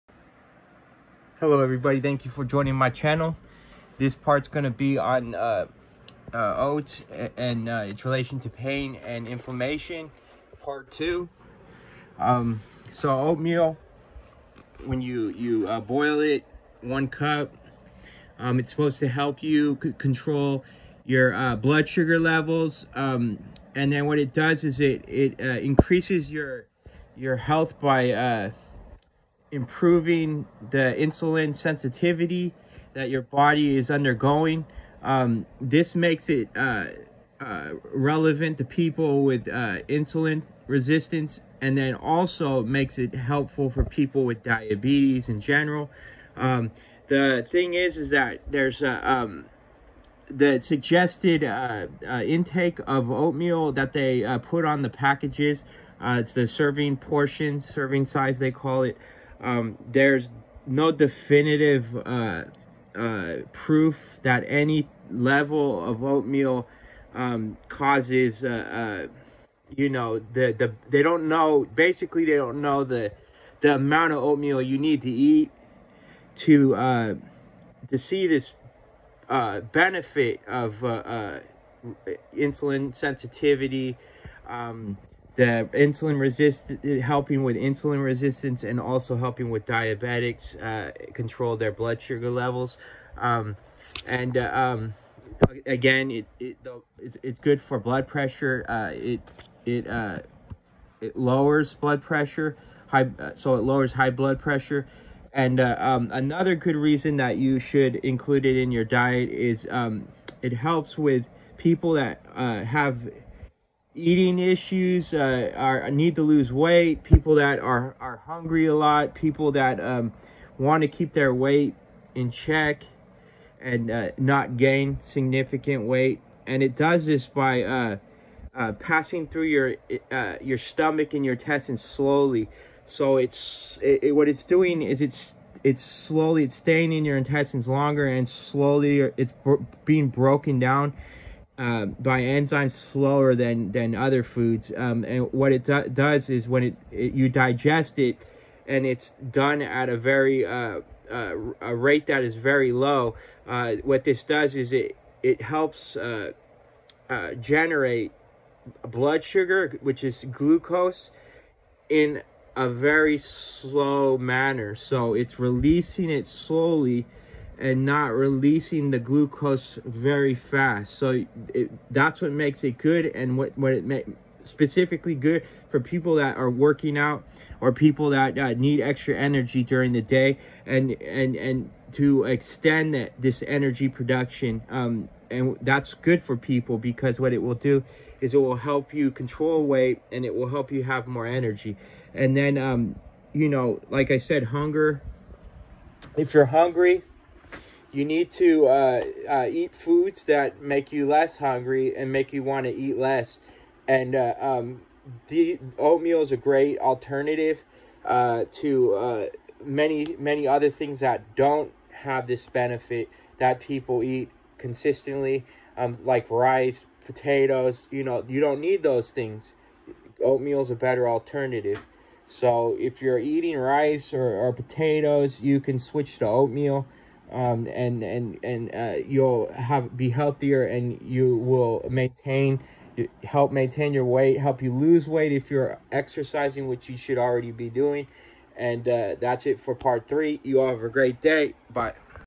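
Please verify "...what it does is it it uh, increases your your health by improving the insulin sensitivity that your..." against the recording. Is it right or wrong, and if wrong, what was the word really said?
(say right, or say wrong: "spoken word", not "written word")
right.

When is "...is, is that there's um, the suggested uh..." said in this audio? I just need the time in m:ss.
0:47.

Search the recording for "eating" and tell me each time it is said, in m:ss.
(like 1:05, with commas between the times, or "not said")
1:53, 3:43.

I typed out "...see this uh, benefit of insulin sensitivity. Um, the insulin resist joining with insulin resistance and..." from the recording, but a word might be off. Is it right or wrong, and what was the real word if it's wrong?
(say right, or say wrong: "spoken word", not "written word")
wrong: "helping", not "joining".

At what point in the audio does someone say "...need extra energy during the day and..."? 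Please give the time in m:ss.
2:58.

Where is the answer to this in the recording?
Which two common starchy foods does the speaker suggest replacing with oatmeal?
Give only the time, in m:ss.
3:36.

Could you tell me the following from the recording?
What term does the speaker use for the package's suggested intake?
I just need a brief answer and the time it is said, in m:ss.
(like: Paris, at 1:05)
serving size, at 0:57.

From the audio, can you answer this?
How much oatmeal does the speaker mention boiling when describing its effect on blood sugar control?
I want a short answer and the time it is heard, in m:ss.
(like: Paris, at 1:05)
one cup, at 0:16.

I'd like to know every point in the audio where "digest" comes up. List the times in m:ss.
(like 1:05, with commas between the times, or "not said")
2:27.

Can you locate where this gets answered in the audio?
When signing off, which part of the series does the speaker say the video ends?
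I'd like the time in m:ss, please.
3:59.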